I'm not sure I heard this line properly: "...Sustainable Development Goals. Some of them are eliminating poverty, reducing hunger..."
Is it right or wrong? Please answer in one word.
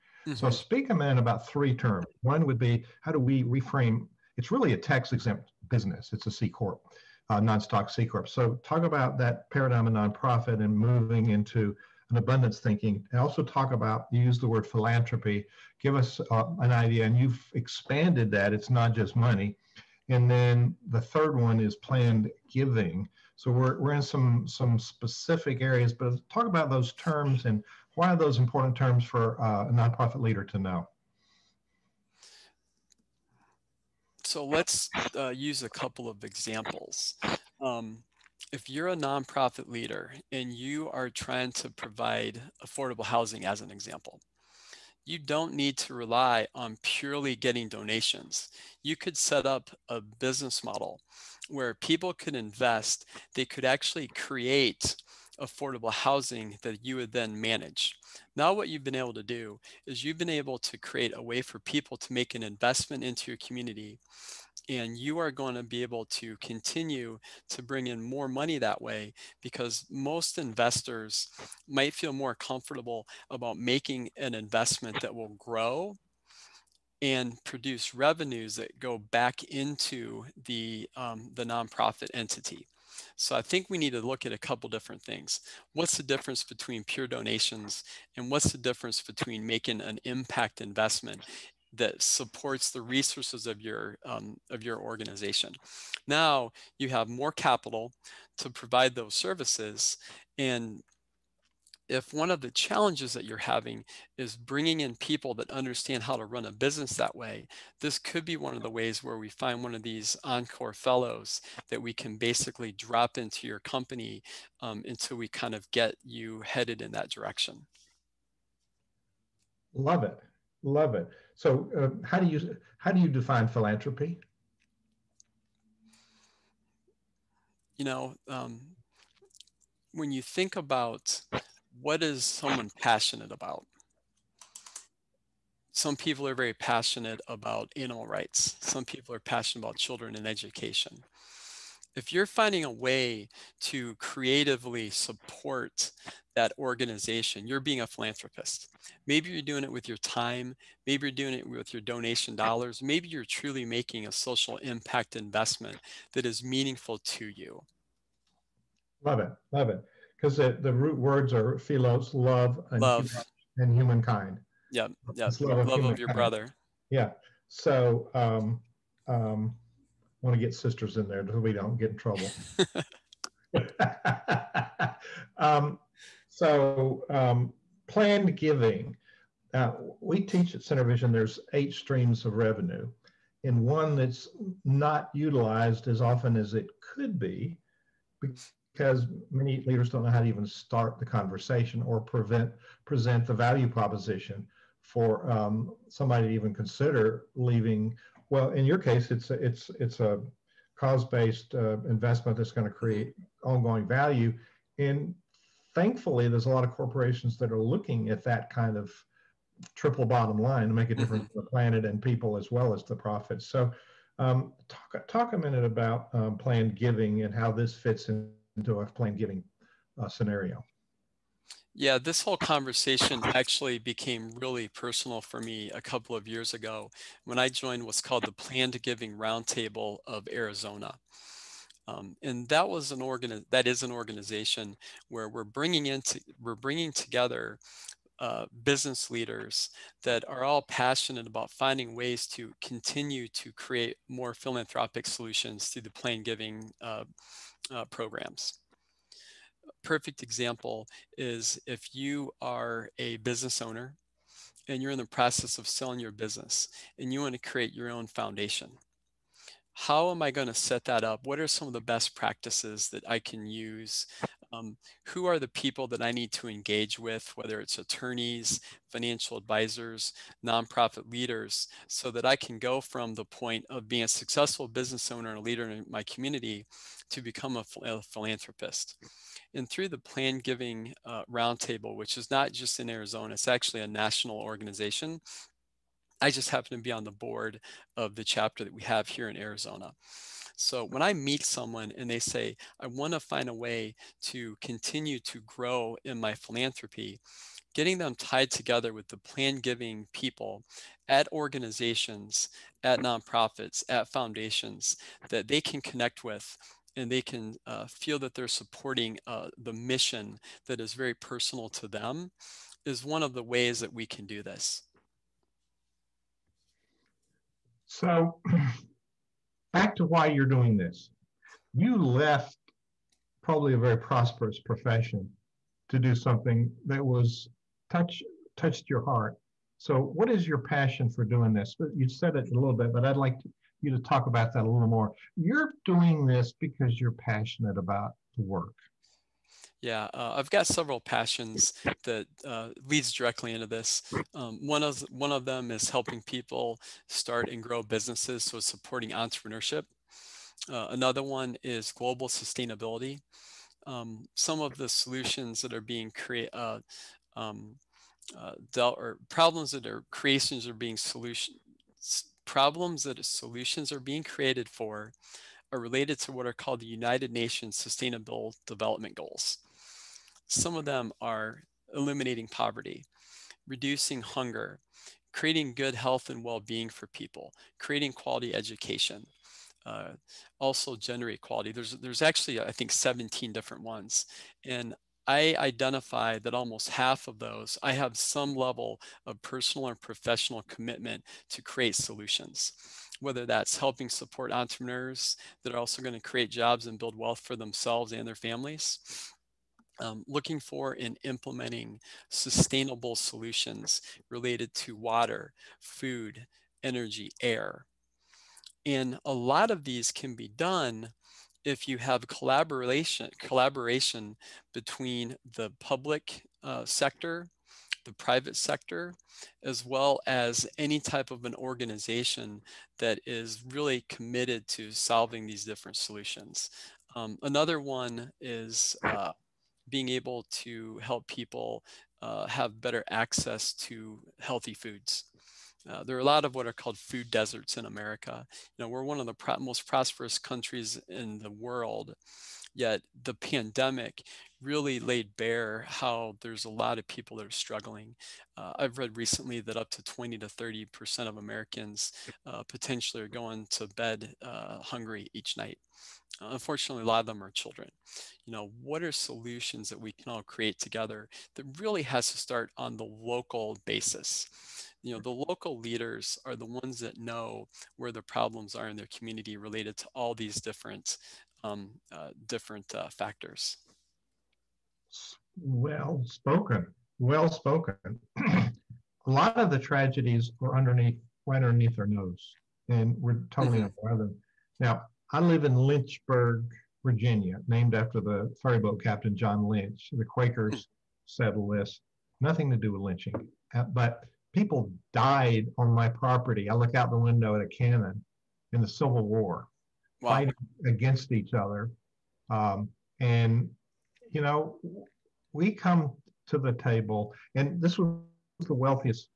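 right.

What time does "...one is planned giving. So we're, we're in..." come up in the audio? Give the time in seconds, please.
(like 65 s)
21 s.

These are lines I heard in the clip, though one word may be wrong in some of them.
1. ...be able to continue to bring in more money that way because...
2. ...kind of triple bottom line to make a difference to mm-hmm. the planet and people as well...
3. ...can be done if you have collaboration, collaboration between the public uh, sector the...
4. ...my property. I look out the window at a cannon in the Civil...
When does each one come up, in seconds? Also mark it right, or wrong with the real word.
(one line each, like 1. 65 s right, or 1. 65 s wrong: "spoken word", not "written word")
1. 65 s right
2. 208 s right
3. 410 s right
4. 495 s right.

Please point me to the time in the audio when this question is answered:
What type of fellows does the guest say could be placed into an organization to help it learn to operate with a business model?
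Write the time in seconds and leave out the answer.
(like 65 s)
110 s.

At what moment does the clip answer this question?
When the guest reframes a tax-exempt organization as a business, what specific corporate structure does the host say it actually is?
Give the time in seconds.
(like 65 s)
7 s.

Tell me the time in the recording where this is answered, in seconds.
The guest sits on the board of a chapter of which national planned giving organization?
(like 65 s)
228 s.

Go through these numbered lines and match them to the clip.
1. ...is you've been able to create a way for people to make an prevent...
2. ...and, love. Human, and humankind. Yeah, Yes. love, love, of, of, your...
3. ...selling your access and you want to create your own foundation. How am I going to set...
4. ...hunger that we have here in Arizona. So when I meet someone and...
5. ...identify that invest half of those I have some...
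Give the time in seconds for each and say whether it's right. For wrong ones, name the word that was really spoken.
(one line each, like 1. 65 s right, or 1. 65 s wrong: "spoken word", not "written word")
1. 59 s wrong: "investment", not "prevent"
2. 162 s right
3. 255 s wrong: "business", not "access"
4. 288 s wrong: "chapter", not "hunger"
5. 385 s wrong: "almost", not "invest".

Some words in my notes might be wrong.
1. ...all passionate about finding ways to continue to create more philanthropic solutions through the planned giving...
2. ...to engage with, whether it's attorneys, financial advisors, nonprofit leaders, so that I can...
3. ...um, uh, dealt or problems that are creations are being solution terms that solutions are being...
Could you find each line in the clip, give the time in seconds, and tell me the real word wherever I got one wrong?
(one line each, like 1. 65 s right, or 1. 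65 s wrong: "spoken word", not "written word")
1. 240 s right
2. 266 s right
3. 357 s wrong: "problems", not "terms".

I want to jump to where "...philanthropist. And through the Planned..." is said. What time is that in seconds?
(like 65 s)
278 s.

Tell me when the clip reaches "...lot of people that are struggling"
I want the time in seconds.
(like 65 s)
446 s.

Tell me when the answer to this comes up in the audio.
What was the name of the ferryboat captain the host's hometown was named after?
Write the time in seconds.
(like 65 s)
489 s.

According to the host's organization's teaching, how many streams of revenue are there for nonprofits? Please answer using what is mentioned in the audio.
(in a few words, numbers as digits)
8.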